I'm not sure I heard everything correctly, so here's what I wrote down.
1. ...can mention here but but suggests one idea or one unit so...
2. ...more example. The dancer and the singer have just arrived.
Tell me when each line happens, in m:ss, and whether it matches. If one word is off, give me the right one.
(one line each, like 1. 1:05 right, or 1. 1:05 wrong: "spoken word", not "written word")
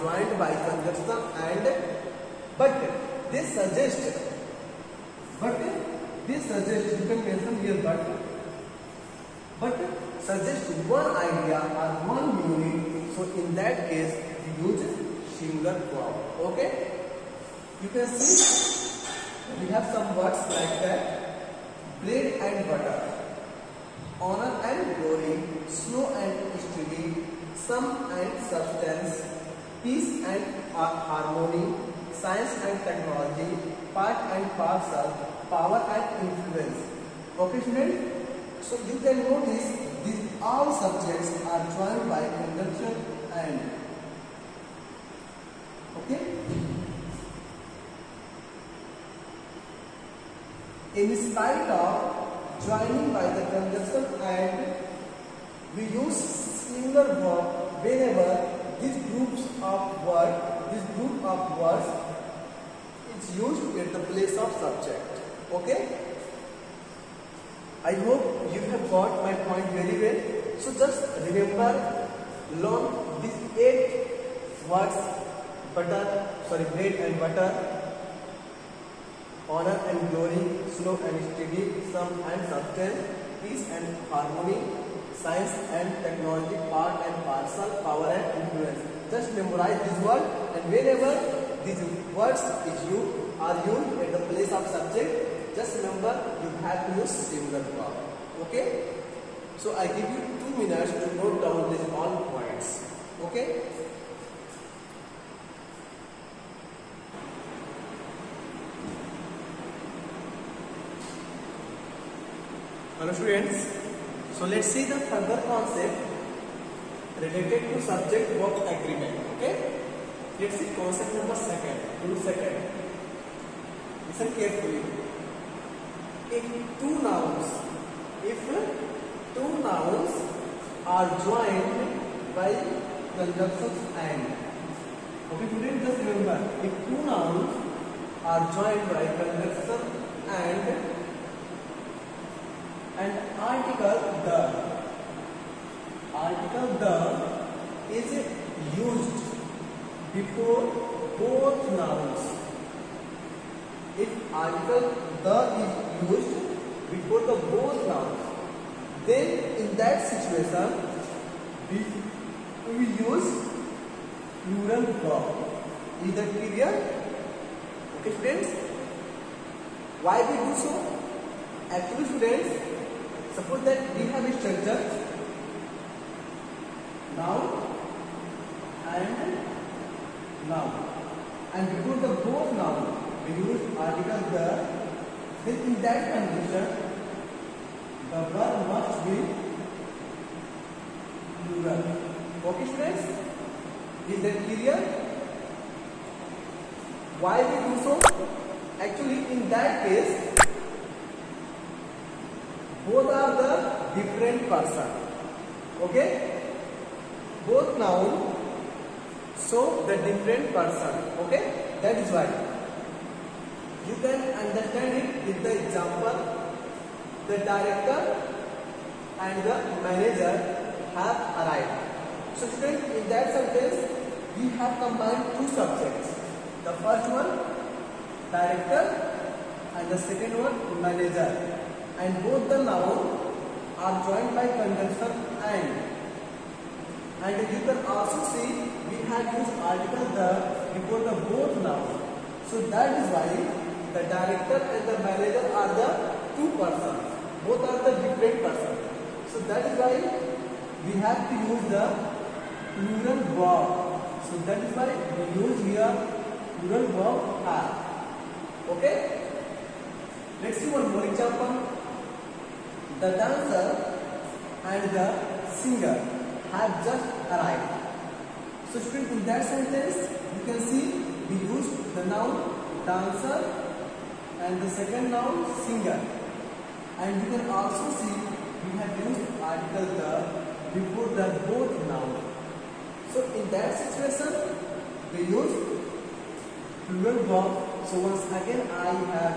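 1. 0:07 right
2. 4:20 right.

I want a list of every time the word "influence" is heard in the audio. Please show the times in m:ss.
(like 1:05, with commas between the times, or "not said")
0:36, 1:28.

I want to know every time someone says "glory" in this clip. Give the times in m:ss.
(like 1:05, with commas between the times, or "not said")
0:24, 1:20.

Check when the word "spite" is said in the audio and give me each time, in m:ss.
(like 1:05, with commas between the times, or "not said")
0:51.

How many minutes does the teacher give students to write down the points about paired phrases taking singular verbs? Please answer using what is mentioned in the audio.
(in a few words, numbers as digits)
2.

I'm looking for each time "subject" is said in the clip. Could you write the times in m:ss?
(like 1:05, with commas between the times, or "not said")
0:40, 1:04, 1:34, 1:57, 3:45.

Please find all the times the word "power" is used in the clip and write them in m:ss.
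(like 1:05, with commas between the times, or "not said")
0:35, 1:27.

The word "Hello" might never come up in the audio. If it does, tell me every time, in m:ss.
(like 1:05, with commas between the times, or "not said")
1:52.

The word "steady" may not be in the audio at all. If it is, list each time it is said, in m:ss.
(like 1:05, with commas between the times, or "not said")
1:21.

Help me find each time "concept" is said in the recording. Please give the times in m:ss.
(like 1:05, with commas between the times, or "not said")
1:55, 2:00.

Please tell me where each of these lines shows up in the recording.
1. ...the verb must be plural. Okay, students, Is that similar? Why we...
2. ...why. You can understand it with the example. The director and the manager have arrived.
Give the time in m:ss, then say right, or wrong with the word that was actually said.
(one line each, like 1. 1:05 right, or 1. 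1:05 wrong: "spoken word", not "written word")
1. 3:08 wrong: "clear", not "similar"
2. 3:32 right.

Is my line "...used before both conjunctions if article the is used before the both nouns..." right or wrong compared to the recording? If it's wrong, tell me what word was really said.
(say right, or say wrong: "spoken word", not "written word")
wrong: "nouns", not "conjunctions".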